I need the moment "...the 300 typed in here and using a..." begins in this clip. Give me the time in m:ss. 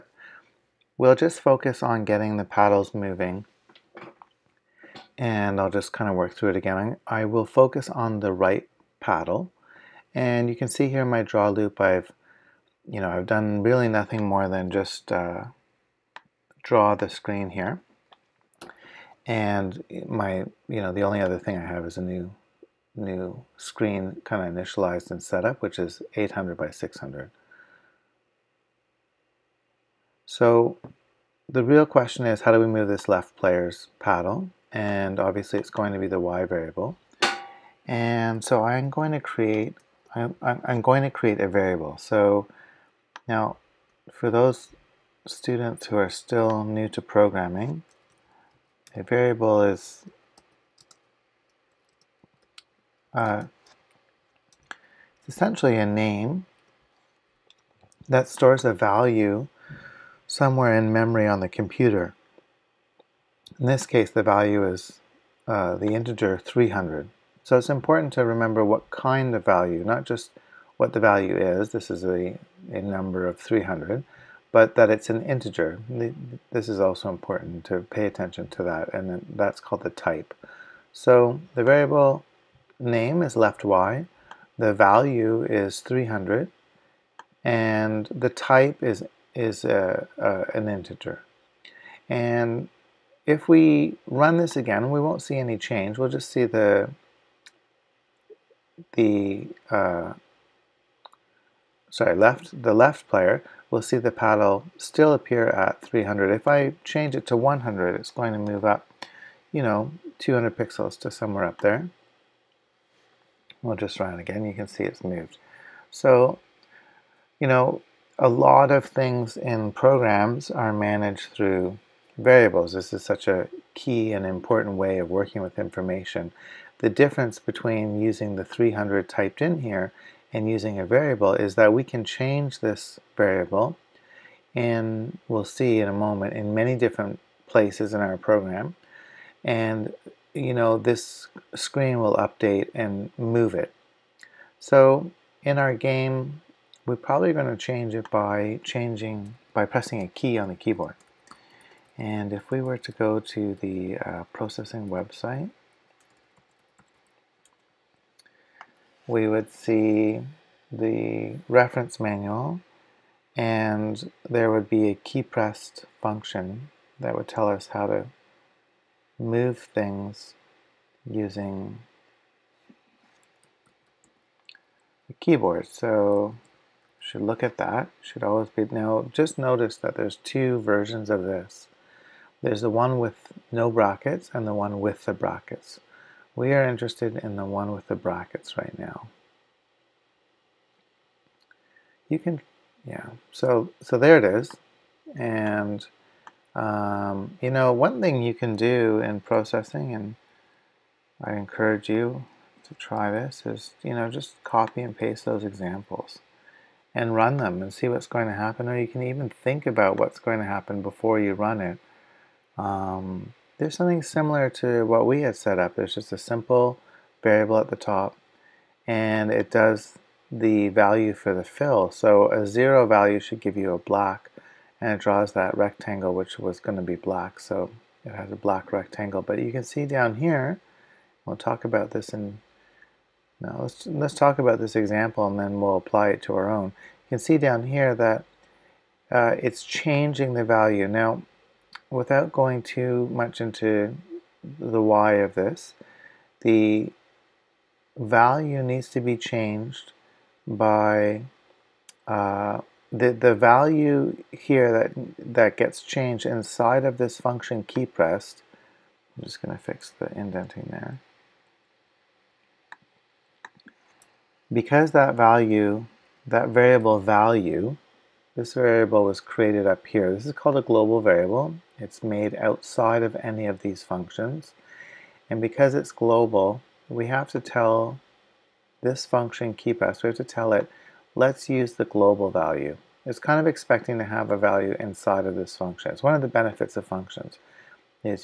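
2:08.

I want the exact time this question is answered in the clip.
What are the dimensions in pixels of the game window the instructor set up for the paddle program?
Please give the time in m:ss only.
0:26.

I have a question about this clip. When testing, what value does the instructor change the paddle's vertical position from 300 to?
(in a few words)
100.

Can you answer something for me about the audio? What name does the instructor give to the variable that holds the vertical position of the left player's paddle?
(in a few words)
left y.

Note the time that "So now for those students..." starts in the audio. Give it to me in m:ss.
0:41.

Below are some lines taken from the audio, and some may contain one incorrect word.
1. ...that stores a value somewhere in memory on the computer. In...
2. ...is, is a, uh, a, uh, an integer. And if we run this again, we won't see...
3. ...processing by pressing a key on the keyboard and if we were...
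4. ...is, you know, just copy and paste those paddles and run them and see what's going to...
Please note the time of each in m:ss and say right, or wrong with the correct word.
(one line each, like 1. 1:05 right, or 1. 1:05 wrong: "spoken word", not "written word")
1. 0:58 right
2. 1:28 right
3. 2:28 wrong: "changing", not "processing"
4. 3:23 wrong: "examples", not "paddles".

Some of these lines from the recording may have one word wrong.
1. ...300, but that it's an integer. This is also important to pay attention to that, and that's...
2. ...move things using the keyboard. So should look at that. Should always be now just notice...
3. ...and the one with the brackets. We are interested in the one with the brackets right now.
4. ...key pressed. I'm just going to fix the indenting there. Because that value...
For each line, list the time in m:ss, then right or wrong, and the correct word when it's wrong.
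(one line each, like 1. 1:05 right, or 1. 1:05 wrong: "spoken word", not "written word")
1. 1:13 right
2. 2:49 right
3. 3:04 right
4. 4:17 right.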